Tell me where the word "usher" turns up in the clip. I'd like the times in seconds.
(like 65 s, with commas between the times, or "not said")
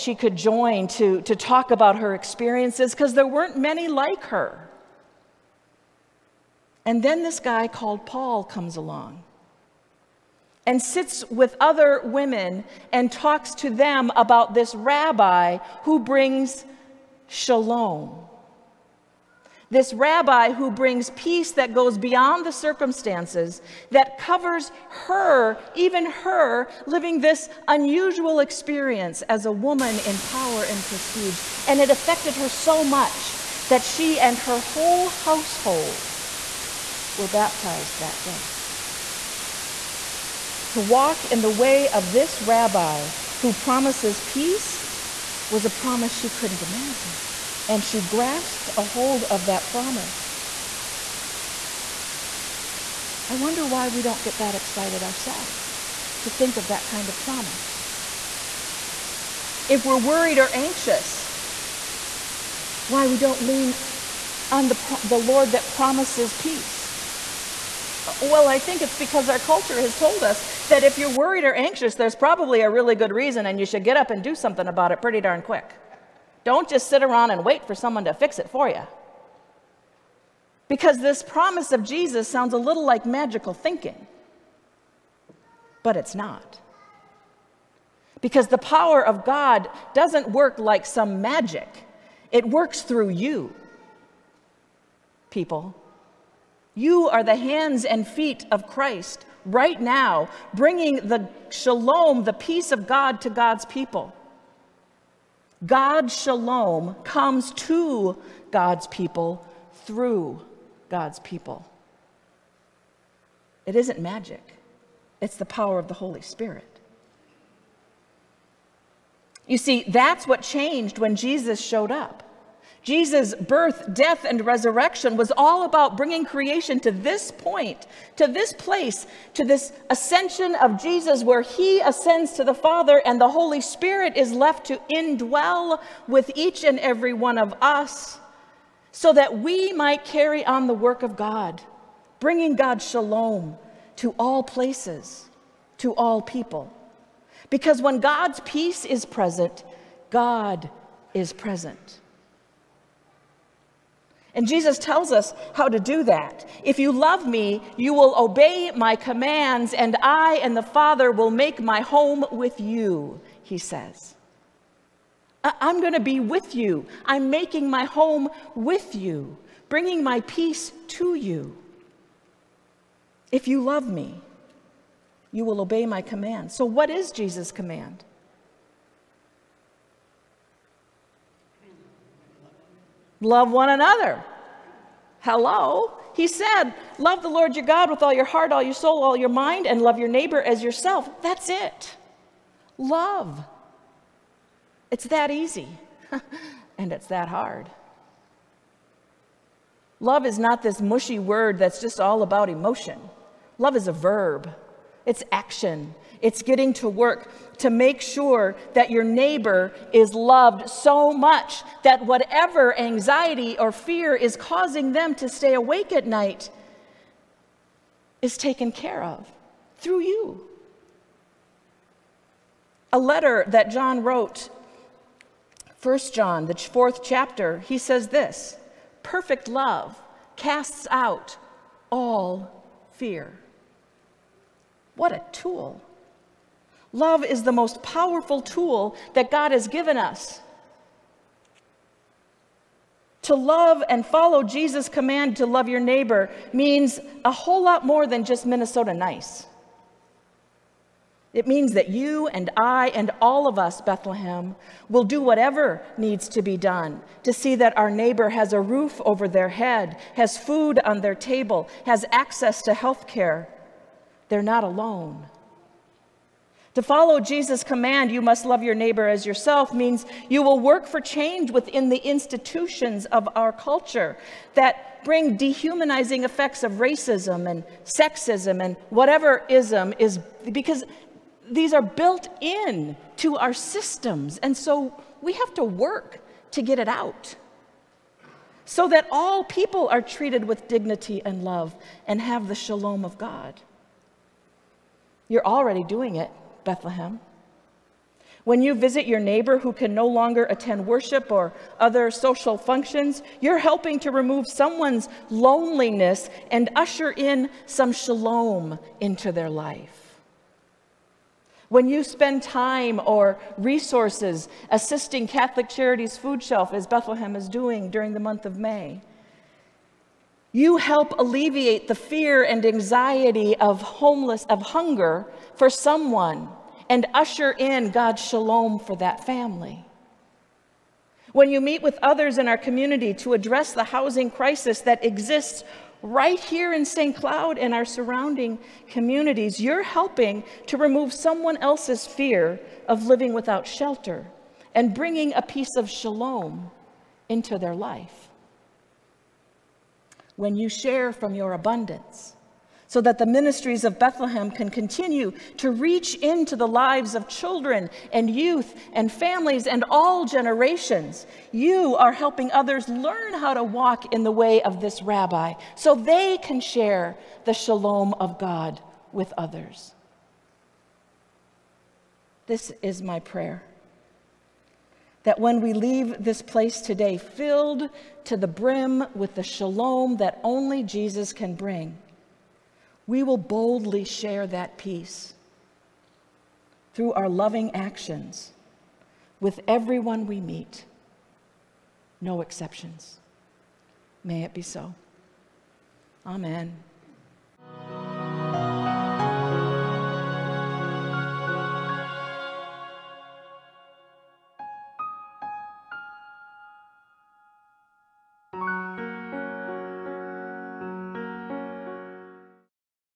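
306 s, 327 s.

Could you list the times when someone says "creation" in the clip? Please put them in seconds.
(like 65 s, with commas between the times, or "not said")
126 s.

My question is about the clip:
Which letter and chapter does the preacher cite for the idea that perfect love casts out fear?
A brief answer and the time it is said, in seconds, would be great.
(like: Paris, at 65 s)
1 John, chapter 4, at 225 s.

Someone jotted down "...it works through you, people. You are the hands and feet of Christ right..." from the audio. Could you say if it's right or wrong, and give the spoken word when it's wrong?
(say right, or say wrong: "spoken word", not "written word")
right.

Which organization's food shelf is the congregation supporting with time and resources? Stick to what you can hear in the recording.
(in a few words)
Catholic Charities.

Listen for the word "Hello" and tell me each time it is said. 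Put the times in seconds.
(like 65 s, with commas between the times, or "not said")
185 s.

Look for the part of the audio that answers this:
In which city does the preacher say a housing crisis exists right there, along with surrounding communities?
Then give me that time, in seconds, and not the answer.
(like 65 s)
336 s.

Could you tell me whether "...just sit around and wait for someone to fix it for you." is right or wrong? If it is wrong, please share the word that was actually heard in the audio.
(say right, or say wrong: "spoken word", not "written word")
right.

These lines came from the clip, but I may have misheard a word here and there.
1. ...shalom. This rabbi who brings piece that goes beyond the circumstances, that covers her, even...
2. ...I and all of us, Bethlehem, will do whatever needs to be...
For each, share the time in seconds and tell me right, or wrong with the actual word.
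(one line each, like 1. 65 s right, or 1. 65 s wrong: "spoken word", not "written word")
1. 17 s wrong: "peace", not "piece"
2. 252 s right.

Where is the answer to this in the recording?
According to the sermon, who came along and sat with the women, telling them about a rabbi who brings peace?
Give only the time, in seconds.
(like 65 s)
8 s.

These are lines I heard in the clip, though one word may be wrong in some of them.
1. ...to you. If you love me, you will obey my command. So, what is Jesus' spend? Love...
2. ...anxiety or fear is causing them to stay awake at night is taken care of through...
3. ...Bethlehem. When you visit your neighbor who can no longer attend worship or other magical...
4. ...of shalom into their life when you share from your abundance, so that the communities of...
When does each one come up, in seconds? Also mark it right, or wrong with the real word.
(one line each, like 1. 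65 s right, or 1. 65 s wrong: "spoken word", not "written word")
1. 170 s wrong: "command", not "spend"
2. 212 s right
3. 296 s wrong: "social", not "magical"
4. 345 s wrong: "ministries", not "communities".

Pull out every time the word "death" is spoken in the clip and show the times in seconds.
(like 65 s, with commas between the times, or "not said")
123 s.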